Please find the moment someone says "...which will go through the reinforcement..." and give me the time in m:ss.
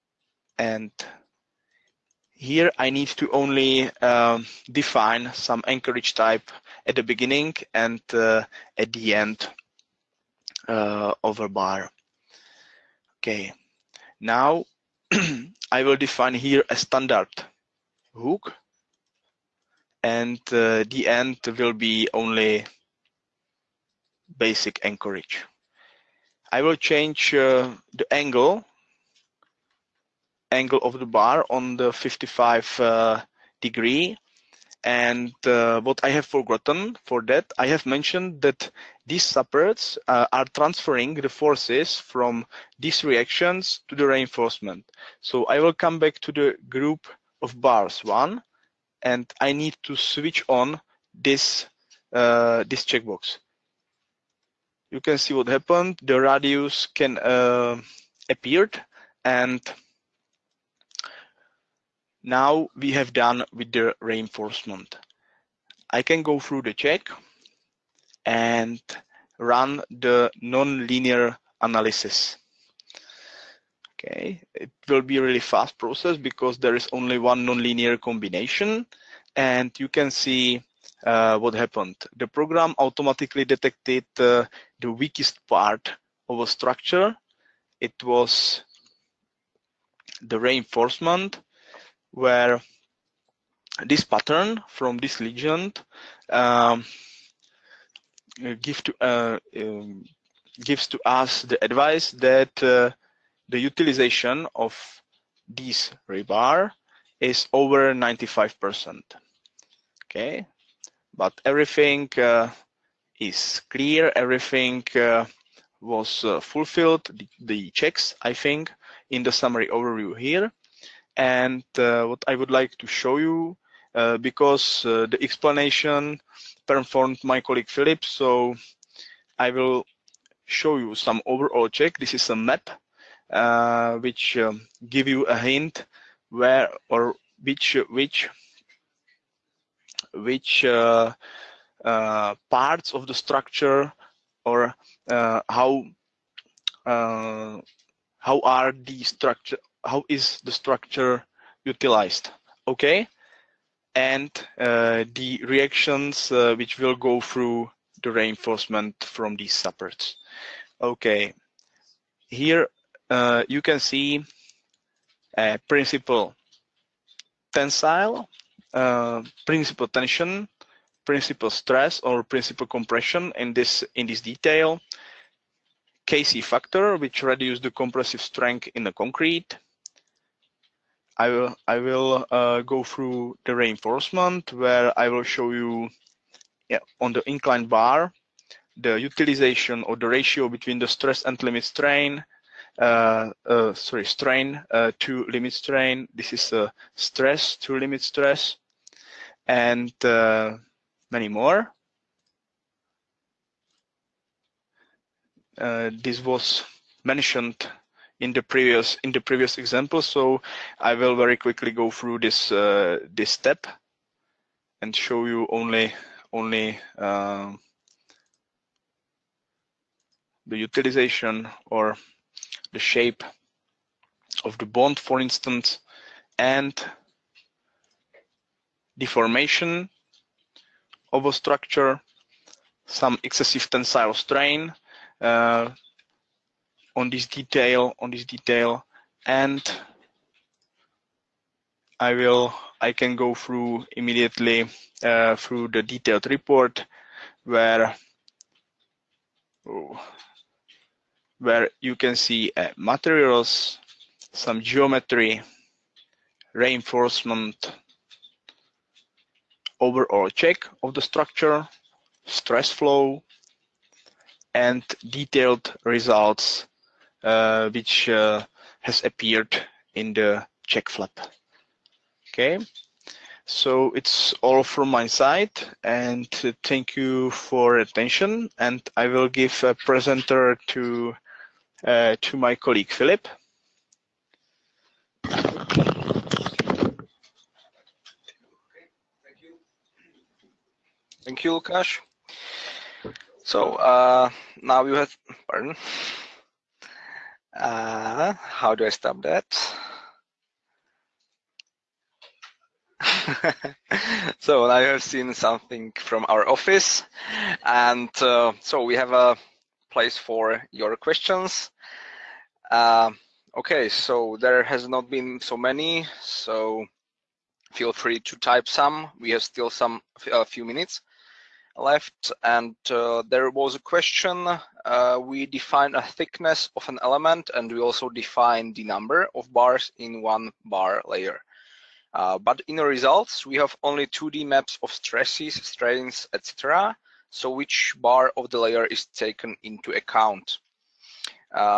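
2:36.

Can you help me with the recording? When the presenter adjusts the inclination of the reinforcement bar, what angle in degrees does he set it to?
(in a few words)
55.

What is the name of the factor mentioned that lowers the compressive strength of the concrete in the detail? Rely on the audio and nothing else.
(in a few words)
KC factor.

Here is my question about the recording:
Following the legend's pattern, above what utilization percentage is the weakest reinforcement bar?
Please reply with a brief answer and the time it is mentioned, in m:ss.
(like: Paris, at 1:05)
95%, at 1:47.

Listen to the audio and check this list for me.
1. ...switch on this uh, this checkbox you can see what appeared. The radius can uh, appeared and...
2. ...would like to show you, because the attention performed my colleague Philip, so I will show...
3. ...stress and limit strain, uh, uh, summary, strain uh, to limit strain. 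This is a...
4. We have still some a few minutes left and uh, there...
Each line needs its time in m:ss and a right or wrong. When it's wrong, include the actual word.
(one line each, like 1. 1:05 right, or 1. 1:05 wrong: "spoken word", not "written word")
1. 0:49 wrong: "happened", not "appeared"
2. 2:02 wrong: "explanation", not "attention"
3. 3:10 wrong: "sorry", not "summary"
4. 5:19 right.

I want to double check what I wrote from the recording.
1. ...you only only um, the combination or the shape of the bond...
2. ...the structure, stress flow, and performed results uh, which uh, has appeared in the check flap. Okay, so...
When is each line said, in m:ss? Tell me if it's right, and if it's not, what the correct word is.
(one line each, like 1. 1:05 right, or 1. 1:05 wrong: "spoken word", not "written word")
1. 3:35 wrong: "utilization", not "combination"
2. 4:20 wrong: "detailed", not "performed".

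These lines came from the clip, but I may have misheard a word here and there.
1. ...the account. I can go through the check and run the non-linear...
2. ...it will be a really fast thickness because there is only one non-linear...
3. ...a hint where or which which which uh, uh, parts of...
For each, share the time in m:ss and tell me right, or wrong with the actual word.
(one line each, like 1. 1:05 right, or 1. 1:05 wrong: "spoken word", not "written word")
1. 1:03 wrong: "reinforcement", not "account"
2. 1:14 wrong: "process", not "thickness"
3. 2:15 right.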